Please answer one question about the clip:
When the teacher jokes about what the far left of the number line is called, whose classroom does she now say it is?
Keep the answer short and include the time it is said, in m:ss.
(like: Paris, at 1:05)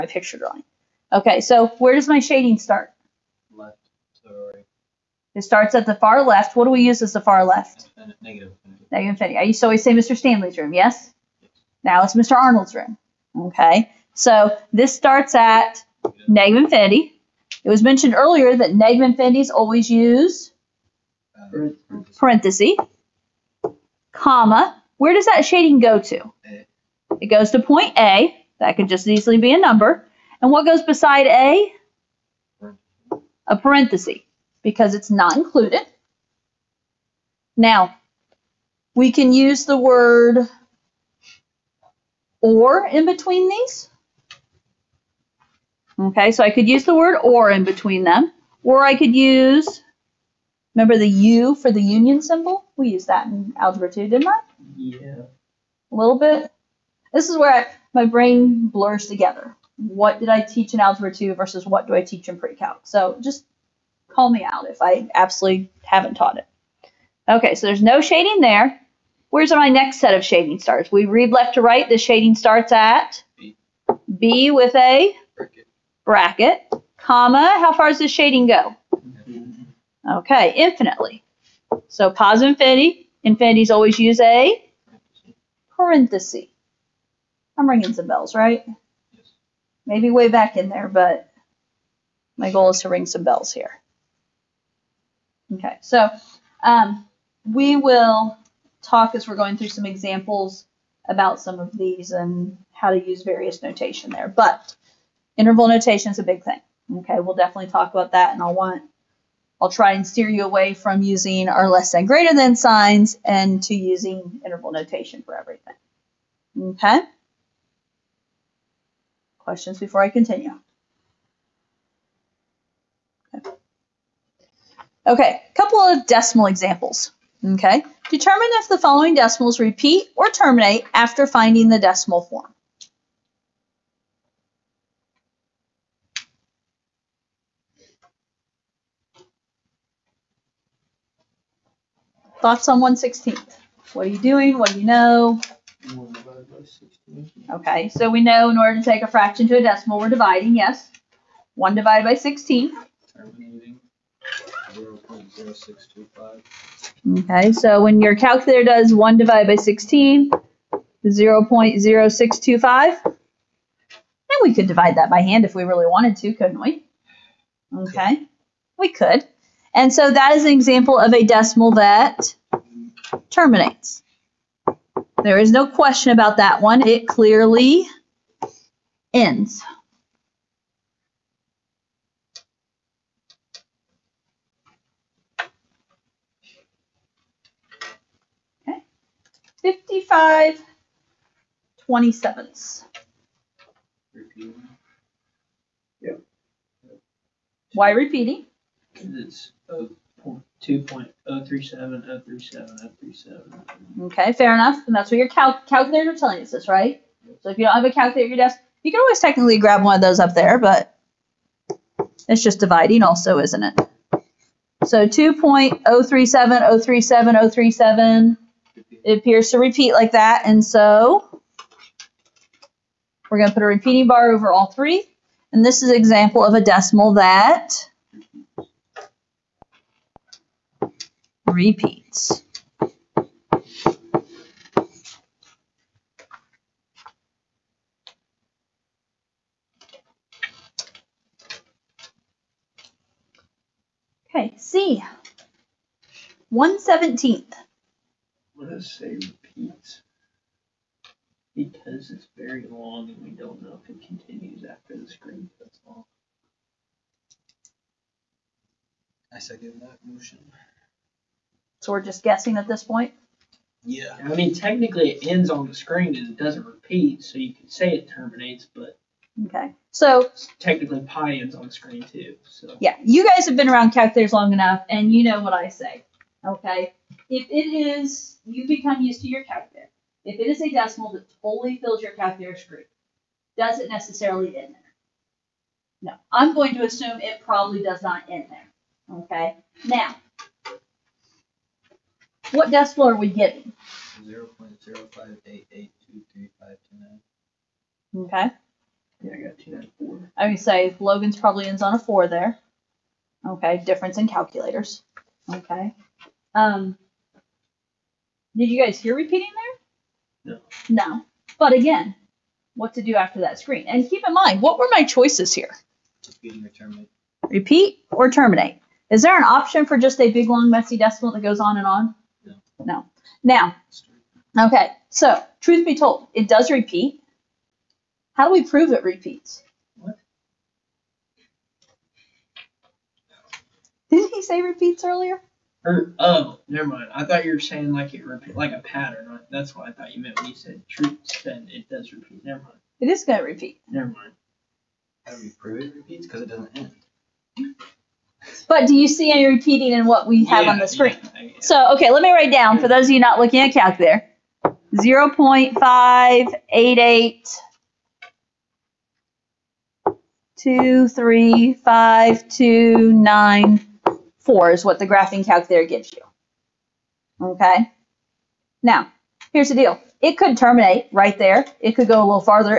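Mr. Arnold's room, at 0:12.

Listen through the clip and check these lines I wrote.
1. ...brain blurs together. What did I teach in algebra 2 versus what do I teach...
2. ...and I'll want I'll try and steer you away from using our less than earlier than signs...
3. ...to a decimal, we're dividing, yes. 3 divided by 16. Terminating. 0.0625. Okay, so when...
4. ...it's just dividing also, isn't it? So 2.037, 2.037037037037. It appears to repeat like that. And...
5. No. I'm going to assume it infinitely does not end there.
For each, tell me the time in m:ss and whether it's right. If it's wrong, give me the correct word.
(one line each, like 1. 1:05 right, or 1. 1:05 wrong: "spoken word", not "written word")
1. 0:58 right
2. 1:48 wrong: "greater", not "earlier"
3. 2:29 wrong: "1", not "3"
4. 3:32 right
5. 4:46 wrong: "probably", not "infinitely".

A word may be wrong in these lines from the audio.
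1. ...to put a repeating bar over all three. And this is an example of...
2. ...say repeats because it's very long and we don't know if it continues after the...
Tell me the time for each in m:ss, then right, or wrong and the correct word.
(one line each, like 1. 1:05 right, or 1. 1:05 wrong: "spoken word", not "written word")
1. 3:43 right
2. 4:08 right.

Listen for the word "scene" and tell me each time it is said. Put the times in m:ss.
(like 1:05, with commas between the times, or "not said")
not said.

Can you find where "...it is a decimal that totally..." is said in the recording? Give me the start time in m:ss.
4:40.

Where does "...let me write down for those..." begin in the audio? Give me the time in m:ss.
5:52.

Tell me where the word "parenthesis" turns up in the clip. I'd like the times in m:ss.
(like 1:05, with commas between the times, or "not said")
0:22, 0:33, 1:25.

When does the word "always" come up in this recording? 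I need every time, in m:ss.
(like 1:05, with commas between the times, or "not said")
0:09, 0:19, 1:23, 3:29.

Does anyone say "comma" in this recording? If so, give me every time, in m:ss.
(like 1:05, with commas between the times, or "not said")
0:24, 1:16.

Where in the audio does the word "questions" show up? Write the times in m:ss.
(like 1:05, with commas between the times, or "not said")
1:59, 2:55.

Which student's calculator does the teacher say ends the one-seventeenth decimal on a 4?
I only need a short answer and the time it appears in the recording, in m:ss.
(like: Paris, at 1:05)
Logan, at 5:00.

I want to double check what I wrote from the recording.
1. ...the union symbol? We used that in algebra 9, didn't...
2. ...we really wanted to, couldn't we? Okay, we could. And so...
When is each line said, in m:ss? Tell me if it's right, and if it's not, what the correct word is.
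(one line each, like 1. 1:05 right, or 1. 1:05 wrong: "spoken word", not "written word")
1. 0:51 wrong: "2", not "9"
2. 2:45 right.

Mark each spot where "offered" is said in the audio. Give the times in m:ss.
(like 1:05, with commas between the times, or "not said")
not said.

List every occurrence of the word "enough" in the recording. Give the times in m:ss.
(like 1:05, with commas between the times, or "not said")
3:24, 4:34.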